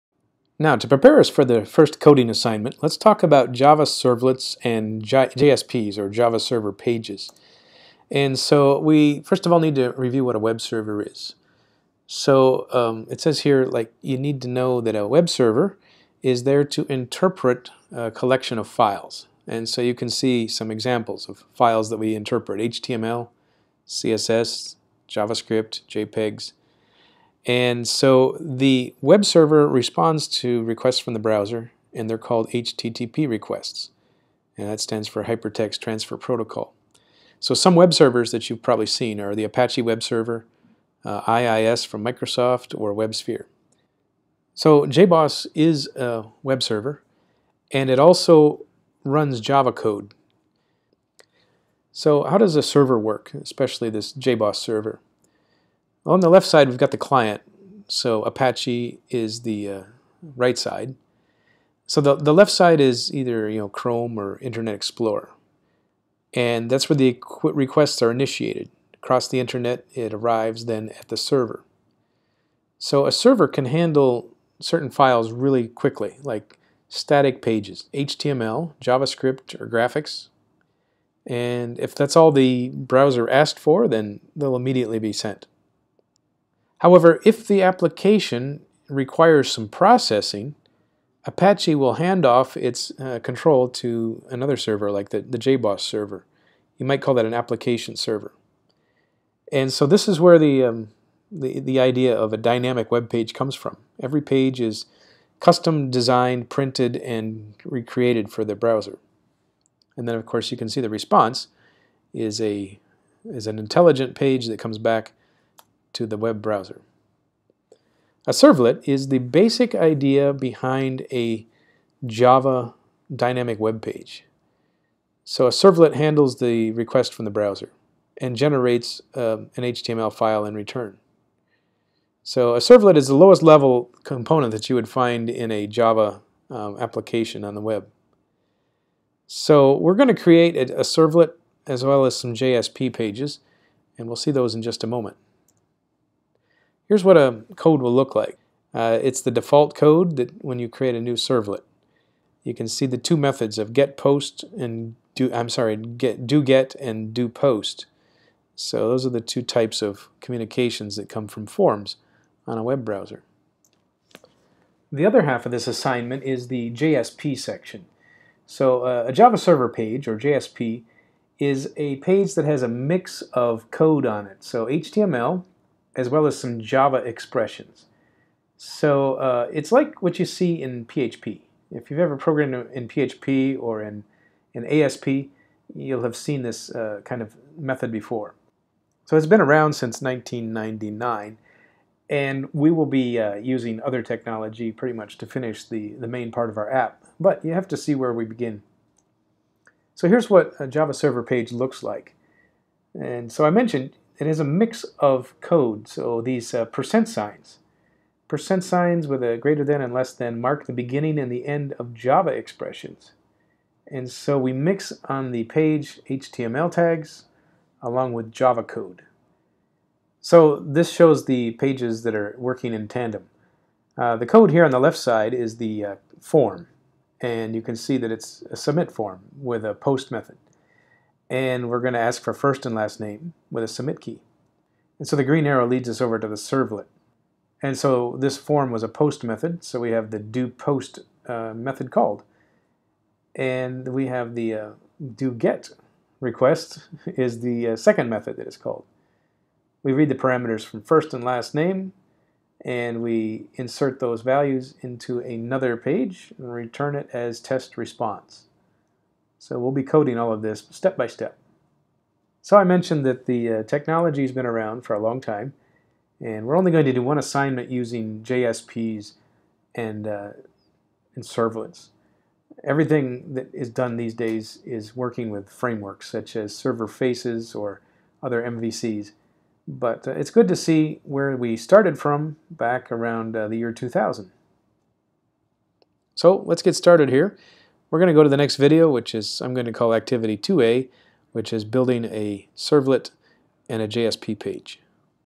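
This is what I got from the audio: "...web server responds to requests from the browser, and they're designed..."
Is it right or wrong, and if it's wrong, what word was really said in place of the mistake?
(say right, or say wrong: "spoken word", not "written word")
wrong: "called", not "designed".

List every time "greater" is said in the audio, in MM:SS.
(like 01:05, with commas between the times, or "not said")
03:29.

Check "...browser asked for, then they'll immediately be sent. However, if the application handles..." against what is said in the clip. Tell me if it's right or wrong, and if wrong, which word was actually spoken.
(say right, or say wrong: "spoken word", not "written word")
wrong: "requires", not "handles".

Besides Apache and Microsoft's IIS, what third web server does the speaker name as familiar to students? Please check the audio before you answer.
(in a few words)
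WebSphere.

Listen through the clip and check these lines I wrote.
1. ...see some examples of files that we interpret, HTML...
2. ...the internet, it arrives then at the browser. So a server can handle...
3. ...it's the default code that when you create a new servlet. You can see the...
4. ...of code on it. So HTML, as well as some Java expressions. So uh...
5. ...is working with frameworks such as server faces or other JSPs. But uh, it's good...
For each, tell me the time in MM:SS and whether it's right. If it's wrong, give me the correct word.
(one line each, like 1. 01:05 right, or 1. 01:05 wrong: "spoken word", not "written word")
1. 00:20 right
2. 01:09 wrong: "server", not "browser"
3. 02:29 right
4. 02:53 right
5. 04:34 wrong: "MVCs", not "JSPs".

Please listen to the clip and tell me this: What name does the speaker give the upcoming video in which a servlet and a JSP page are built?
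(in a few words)
Activity 2A.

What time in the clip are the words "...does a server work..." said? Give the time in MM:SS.
00:52.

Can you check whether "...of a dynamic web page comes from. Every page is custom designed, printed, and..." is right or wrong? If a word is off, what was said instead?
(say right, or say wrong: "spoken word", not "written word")
right.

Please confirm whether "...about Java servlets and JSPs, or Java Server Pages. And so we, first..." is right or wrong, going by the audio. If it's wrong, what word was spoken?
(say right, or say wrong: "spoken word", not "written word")
right.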